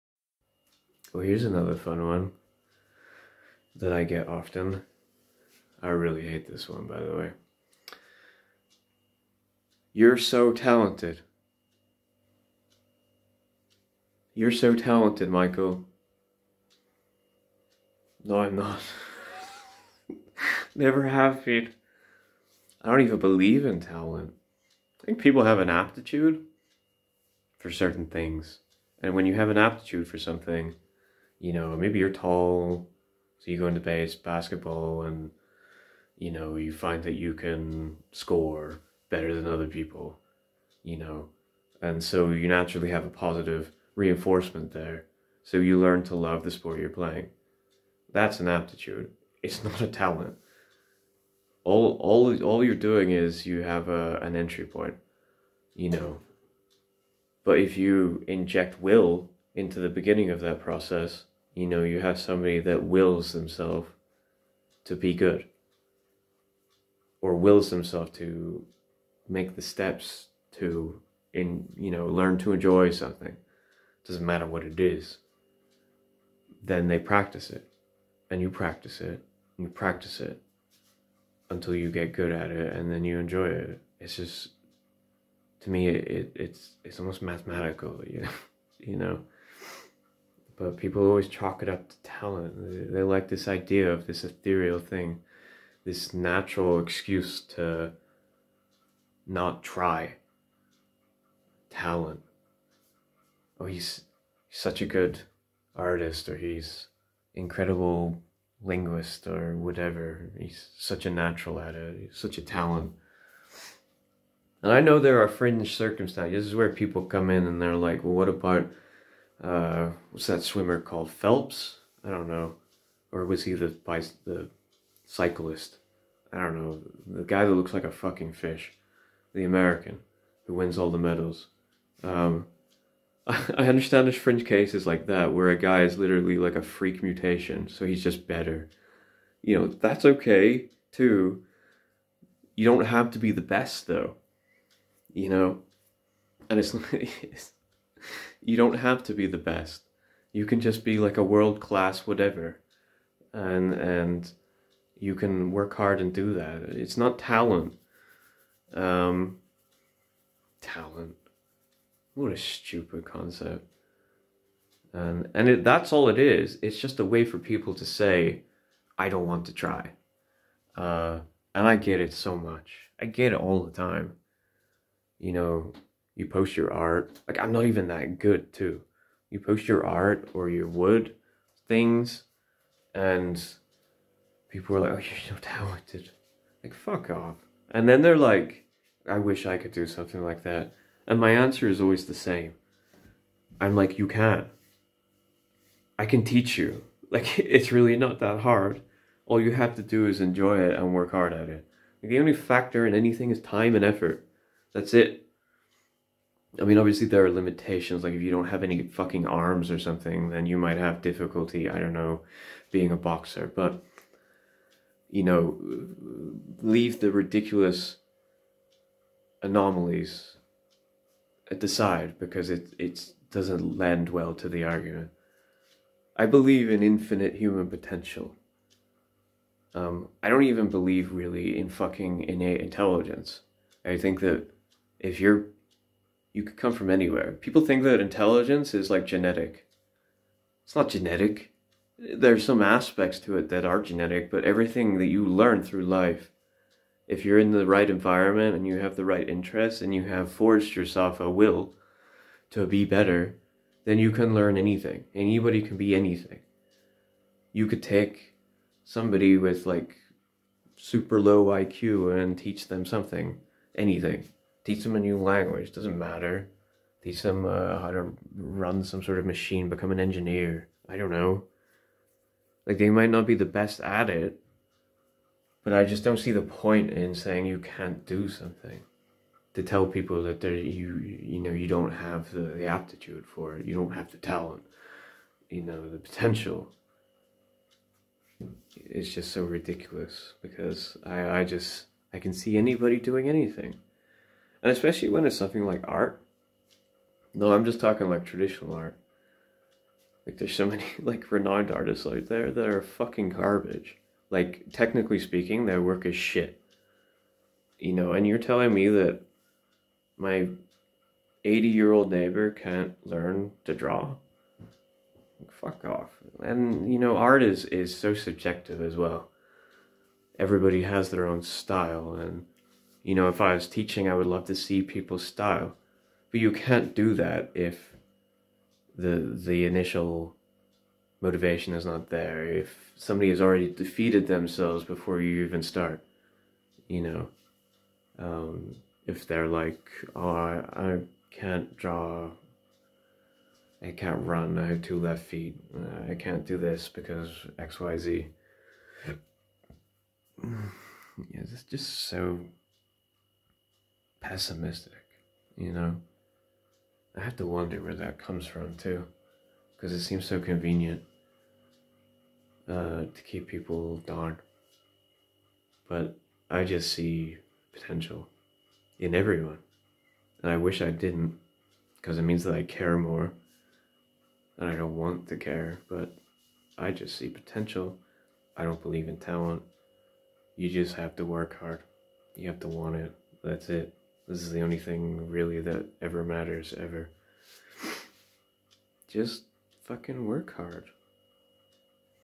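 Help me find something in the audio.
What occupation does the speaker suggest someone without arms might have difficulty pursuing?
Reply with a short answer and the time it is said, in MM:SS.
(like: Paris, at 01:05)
Boxer, at 03:32.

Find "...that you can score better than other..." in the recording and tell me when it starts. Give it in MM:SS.
00:37.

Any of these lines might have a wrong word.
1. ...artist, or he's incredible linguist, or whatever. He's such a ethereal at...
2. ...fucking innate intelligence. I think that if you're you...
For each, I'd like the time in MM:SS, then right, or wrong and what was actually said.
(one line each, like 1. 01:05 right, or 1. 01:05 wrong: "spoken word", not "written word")
1. 01:45 wrong: "natural", not "ethereal"
2. 03:51 right.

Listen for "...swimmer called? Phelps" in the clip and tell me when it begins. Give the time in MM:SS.
02:00.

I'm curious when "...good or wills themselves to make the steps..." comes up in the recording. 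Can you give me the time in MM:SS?
01:05.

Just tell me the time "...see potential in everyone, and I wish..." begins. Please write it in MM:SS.
06:06.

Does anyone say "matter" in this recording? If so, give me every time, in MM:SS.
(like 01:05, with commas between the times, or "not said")
01:14, 04:25, 06:26.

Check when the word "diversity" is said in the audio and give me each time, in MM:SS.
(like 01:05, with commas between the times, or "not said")
not said.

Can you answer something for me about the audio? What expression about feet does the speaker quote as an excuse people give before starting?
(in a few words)
Two left feet.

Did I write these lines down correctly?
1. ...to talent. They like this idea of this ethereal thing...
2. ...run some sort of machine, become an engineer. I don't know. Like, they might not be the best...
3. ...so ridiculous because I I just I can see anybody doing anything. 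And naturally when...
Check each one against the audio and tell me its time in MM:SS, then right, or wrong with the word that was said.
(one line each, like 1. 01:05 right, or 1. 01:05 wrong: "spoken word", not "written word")
1. 01:31 right
2. 04:28 right
3. 04:49 wrong: "especially", not "naturally".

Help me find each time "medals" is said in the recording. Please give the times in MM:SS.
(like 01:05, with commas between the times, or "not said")
02:10.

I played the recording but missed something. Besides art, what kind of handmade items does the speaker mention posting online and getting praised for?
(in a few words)
Wood things.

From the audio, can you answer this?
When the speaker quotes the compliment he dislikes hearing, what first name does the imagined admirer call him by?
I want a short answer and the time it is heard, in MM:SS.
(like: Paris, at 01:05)
Michael, at 00:15.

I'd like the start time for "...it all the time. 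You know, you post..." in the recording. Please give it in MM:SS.
02:53.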